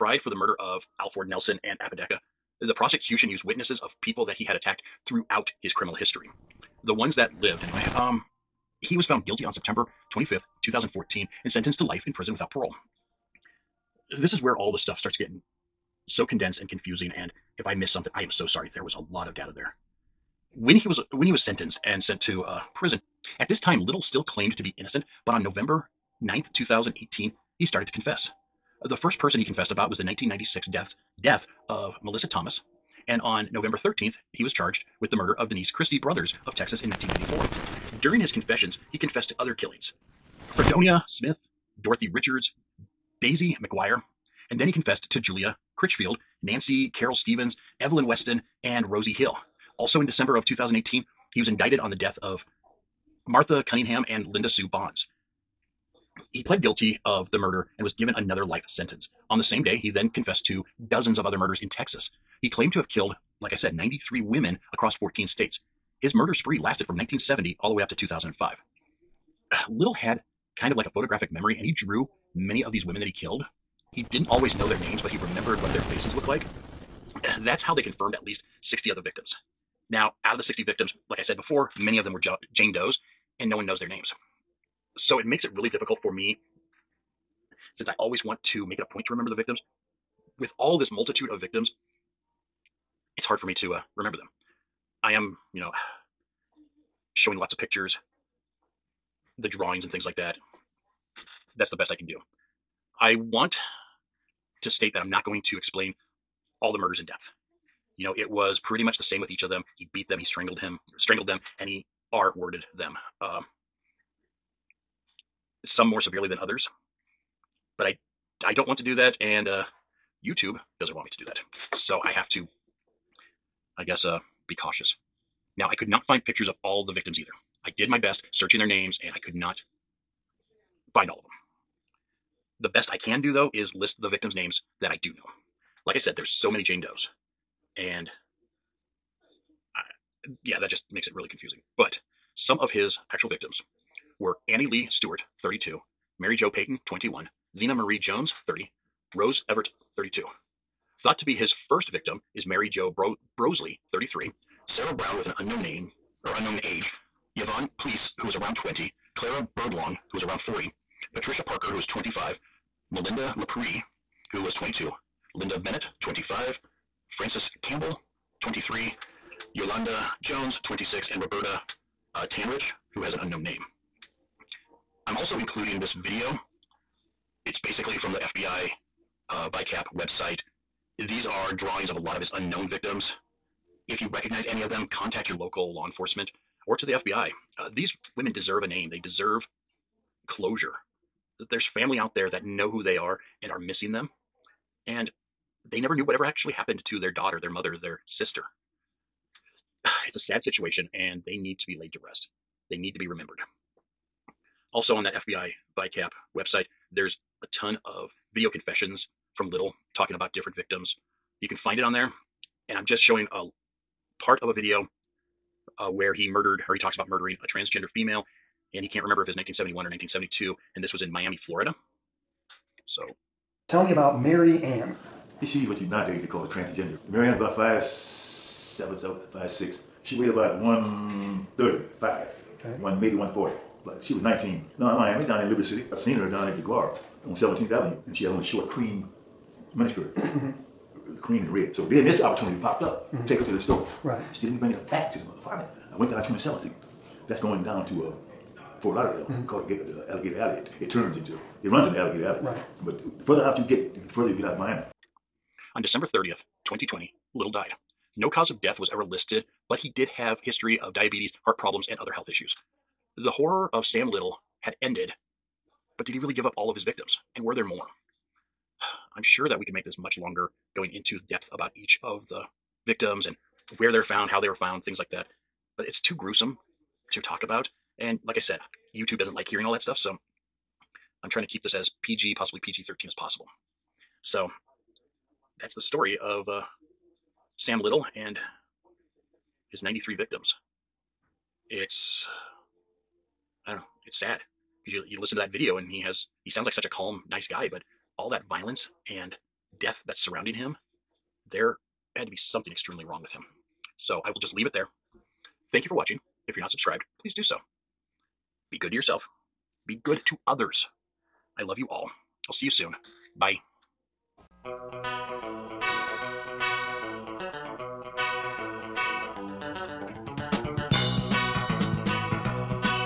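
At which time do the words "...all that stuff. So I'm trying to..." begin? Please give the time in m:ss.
4:39.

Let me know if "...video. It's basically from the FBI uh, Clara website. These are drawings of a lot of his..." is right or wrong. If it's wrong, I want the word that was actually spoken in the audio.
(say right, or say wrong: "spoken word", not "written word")
wrong: "VICAP", not "Clara".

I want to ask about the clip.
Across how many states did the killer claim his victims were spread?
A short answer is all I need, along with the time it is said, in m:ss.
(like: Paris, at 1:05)
14, at 1:04.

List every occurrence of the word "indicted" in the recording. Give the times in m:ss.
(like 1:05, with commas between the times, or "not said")
0:51.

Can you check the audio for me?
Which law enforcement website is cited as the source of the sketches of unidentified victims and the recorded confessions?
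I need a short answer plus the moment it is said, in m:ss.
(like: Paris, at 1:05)
FBI VICAP, at 3:25.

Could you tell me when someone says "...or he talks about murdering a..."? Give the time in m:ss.
3:36.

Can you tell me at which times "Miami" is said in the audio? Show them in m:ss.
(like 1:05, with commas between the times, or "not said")
3:41, 3:54, 4:14.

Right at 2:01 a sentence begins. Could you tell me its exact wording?
So I have to, I guess, uh, be cautious.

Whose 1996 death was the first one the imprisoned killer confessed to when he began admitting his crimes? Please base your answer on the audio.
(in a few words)
Melissa Thomas.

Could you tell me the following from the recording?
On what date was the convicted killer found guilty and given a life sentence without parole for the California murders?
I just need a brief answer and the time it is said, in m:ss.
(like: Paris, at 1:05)
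September 25th, 2014, at 0:09.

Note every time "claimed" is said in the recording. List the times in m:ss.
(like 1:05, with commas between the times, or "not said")
0:24, 1:02.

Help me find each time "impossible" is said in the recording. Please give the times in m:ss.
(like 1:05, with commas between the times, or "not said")
not said.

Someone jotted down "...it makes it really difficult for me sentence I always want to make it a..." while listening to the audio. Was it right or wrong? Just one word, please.
wrong.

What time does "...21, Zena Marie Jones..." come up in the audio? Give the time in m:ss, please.
2:26.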